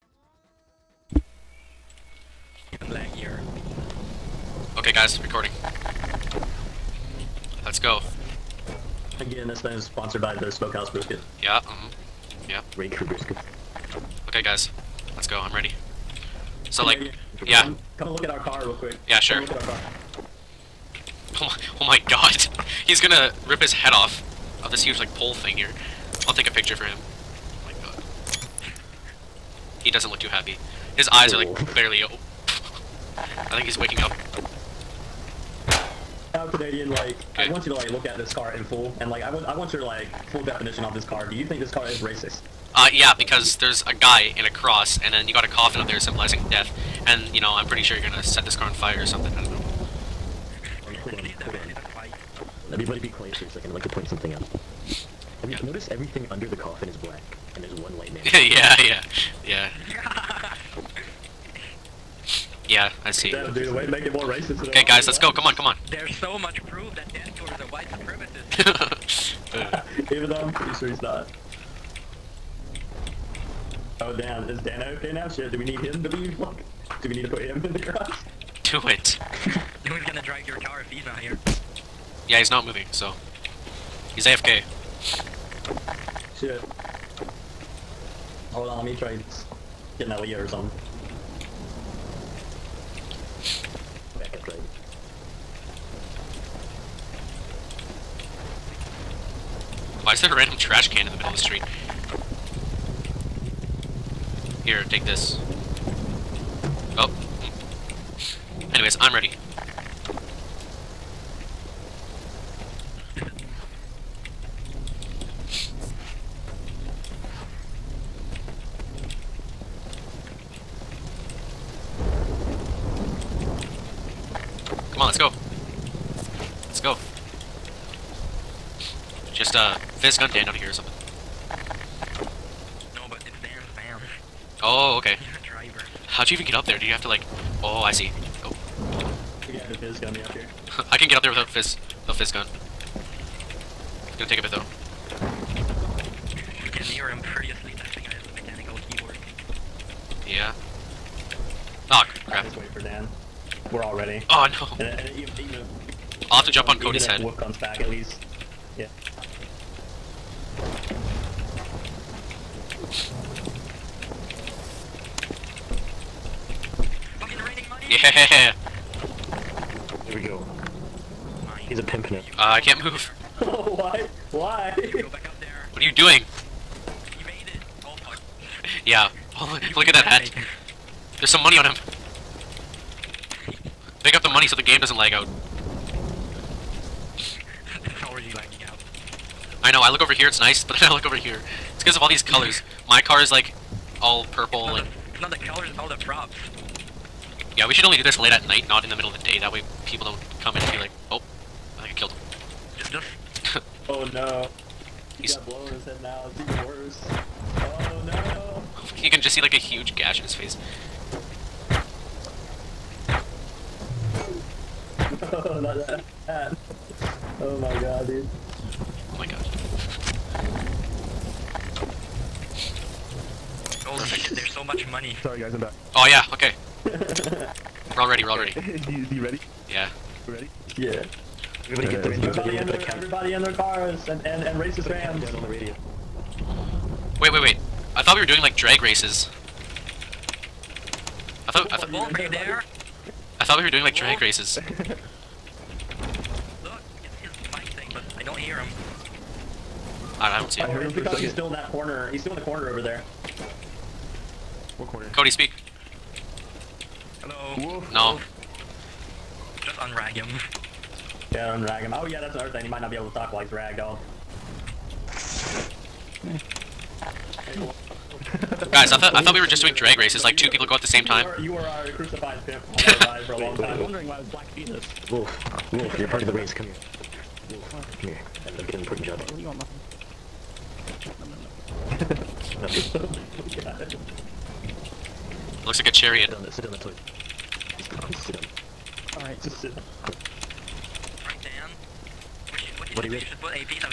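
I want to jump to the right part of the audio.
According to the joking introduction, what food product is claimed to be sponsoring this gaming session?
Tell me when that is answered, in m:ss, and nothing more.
0:10.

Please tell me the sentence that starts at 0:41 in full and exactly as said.
Do you think this car is racist?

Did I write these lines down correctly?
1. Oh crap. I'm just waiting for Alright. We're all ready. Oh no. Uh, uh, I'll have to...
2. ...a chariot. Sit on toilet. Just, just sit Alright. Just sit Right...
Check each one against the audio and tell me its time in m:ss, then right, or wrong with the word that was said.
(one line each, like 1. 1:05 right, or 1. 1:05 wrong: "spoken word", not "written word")
1. 2:31 wrong: "Dan", not "Alright"
2. 4:45 right.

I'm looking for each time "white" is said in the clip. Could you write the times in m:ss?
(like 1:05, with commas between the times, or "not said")
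0:57, 1:07.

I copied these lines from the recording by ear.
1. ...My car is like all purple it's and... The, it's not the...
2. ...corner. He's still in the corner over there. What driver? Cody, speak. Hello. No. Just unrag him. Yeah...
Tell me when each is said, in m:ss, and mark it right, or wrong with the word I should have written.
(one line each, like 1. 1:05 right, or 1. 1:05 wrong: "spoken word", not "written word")
1. 3:12 right
2. 4:11 wrong: "corner", not "driver".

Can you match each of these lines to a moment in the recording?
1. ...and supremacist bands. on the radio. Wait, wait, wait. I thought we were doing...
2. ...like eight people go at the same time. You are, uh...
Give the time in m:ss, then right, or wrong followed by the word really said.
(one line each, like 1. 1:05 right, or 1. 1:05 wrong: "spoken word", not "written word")
1. 3:54 wrong: "racist", not "supremacist"
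2. 4:30 wrong: "two", not "eight".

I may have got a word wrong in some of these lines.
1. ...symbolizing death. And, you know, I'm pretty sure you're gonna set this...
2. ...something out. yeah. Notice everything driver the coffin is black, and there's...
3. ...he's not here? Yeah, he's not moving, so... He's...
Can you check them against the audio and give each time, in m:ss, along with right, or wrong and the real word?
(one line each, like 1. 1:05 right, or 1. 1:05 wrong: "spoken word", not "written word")
1. 0:45 right
2. 0:54 wrong: "under", not "driver"
3. 1:20 right.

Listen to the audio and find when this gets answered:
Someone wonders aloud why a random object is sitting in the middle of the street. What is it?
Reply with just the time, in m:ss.
1:40.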